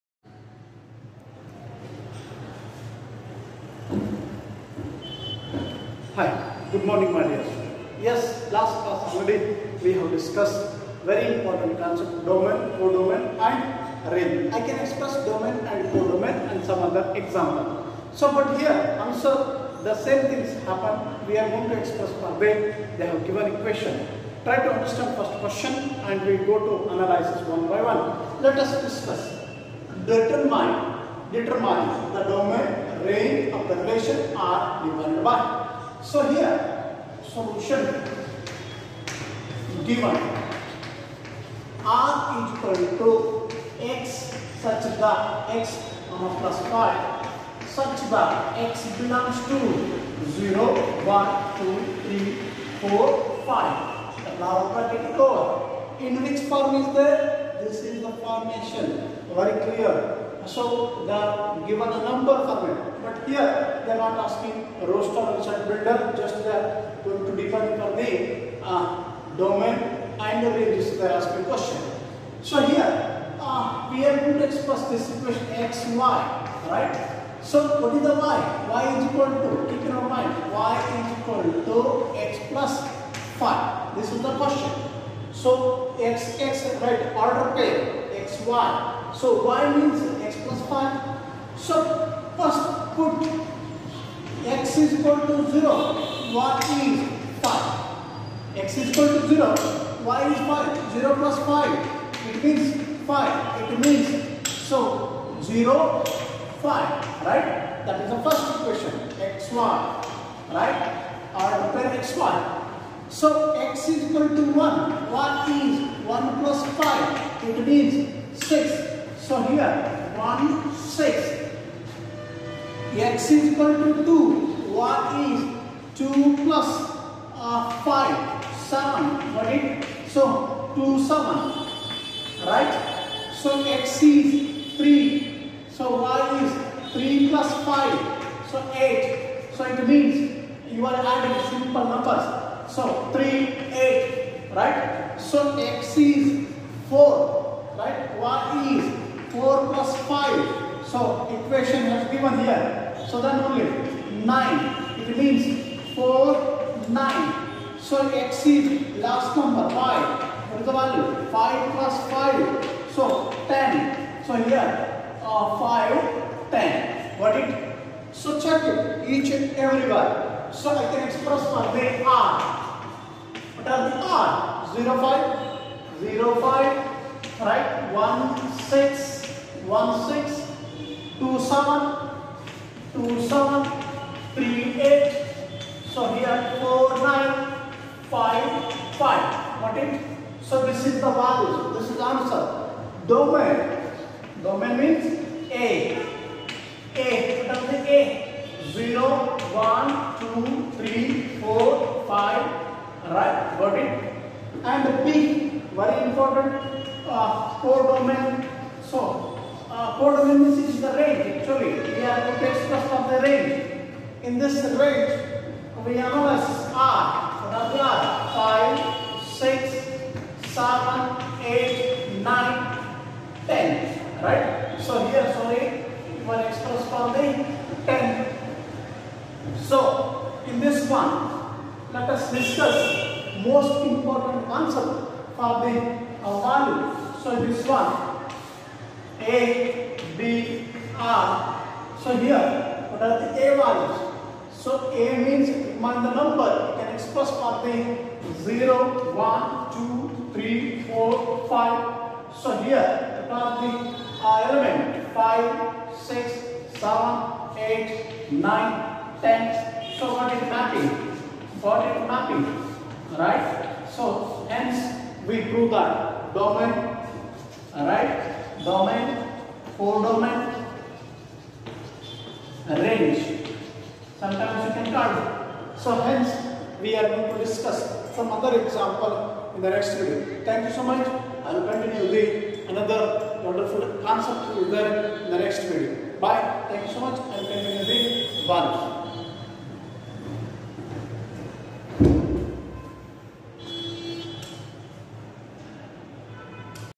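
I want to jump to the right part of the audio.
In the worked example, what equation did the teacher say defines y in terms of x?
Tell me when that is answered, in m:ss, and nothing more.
1:20.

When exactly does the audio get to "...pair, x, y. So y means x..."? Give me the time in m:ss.
1:27.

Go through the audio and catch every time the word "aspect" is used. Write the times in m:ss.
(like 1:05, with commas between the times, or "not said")
1:11.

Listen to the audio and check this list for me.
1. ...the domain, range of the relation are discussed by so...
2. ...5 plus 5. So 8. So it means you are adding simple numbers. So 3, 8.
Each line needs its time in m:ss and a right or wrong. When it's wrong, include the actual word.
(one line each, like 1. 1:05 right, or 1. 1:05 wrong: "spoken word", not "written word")
1. 0:32 wrong: "divided", not "discussed"
2. 2:16 wrong: "3", not "5".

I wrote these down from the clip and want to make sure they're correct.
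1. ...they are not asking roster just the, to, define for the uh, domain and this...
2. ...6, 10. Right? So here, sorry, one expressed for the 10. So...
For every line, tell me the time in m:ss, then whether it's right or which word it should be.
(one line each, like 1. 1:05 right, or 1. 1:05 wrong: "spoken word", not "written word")
1. 1:03 right
2. 3:42 wrong: "9", not "6".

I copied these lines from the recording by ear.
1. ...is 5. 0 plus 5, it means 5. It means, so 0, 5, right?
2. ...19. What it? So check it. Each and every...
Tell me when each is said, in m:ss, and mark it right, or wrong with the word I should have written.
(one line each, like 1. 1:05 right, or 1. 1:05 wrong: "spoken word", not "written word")
1. 1:40 right
2. 2:46 wrong: "10", not "19".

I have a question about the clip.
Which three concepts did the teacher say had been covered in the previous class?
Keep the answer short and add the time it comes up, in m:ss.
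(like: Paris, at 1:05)
domain, codomain and range, at 0:12.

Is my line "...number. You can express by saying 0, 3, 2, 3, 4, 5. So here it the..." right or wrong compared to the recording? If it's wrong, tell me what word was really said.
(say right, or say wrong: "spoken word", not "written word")
wrong: "1", not "3".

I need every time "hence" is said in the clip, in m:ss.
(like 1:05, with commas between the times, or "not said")
4:24, 4:36.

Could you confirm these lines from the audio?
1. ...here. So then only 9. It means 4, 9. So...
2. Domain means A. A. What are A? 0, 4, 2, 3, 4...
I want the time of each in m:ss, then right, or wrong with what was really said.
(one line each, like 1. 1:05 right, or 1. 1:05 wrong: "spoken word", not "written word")
1. 2:32 right
2. 3:14 wrong: "1", not "4".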